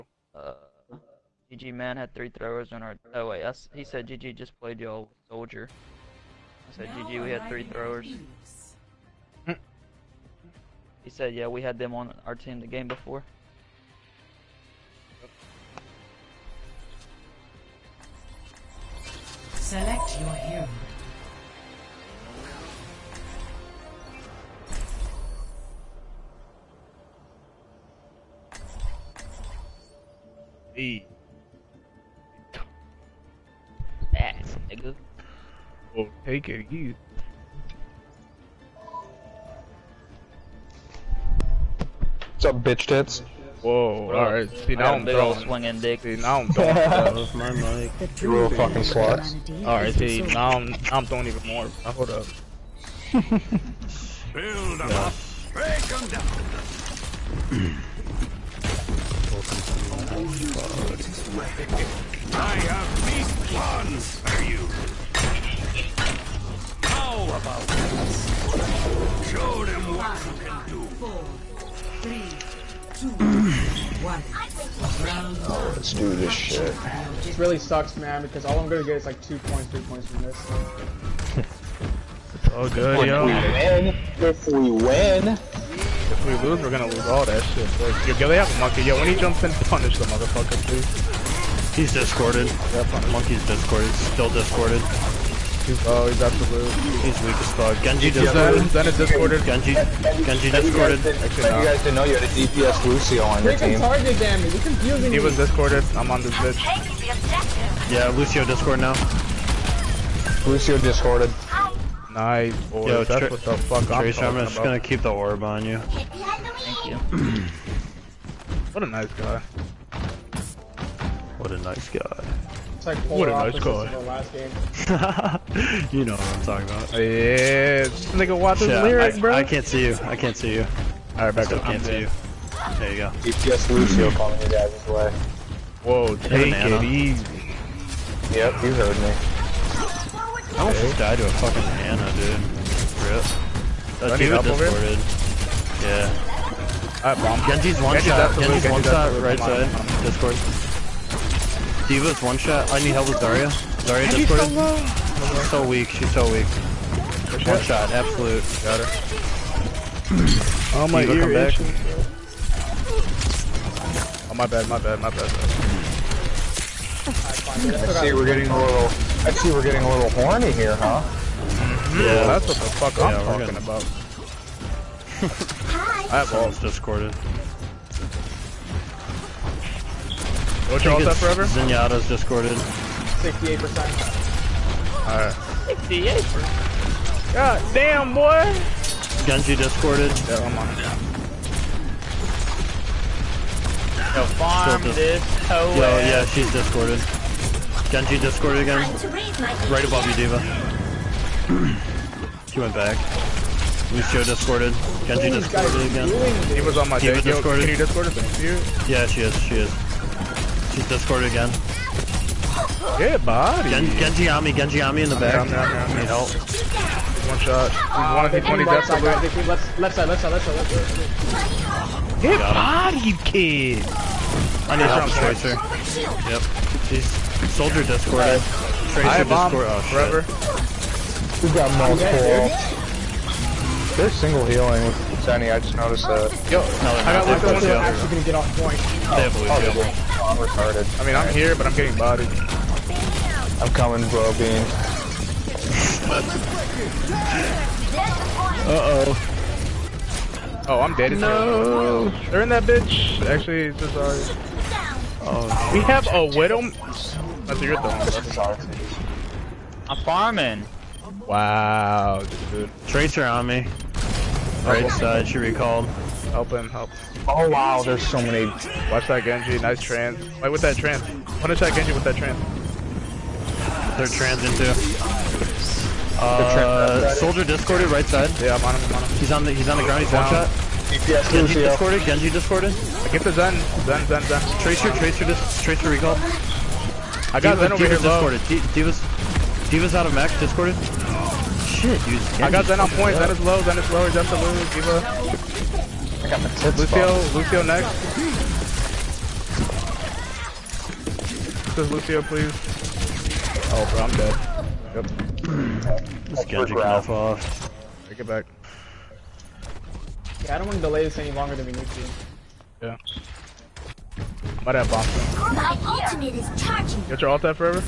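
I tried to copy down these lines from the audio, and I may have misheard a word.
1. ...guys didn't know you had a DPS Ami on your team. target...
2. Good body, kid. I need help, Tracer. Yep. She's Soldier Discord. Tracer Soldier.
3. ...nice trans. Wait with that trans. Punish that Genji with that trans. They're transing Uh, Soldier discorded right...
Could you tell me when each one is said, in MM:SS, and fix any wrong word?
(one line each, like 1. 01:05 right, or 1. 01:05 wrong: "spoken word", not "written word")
1. 01:41 wrong: "Lucio", not "Ami"
2. 03:42 wrong: "Discord", not "Soldier"
3. 04:29 right.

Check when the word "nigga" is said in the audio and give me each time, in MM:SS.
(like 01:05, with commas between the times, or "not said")
00:34, 02:08.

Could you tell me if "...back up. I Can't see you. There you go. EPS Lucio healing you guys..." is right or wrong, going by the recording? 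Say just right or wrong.
wrong.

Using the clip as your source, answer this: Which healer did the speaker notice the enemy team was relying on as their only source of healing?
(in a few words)
Zenyatta.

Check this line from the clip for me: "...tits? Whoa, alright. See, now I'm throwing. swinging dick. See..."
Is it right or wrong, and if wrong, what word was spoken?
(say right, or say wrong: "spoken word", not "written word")
right.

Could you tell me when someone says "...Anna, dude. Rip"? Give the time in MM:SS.
02:21.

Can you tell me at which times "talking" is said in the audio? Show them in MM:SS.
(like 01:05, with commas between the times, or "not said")
02:06, 02:53.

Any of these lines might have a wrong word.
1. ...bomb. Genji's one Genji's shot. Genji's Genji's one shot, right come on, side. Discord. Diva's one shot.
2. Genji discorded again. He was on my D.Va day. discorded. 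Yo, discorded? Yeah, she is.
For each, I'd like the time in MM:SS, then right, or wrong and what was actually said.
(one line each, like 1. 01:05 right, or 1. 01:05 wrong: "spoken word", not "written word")
1. 02:27 right
2. 03:25 right.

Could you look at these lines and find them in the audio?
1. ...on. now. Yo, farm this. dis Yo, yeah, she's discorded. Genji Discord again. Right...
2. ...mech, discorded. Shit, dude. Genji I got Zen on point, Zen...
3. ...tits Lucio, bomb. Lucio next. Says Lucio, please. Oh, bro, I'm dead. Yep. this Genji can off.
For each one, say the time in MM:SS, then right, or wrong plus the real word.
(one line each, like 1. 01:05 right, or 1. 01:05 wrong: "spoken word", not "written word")
1. 03:10 right
2. 04:50 right
3. 04:56 right.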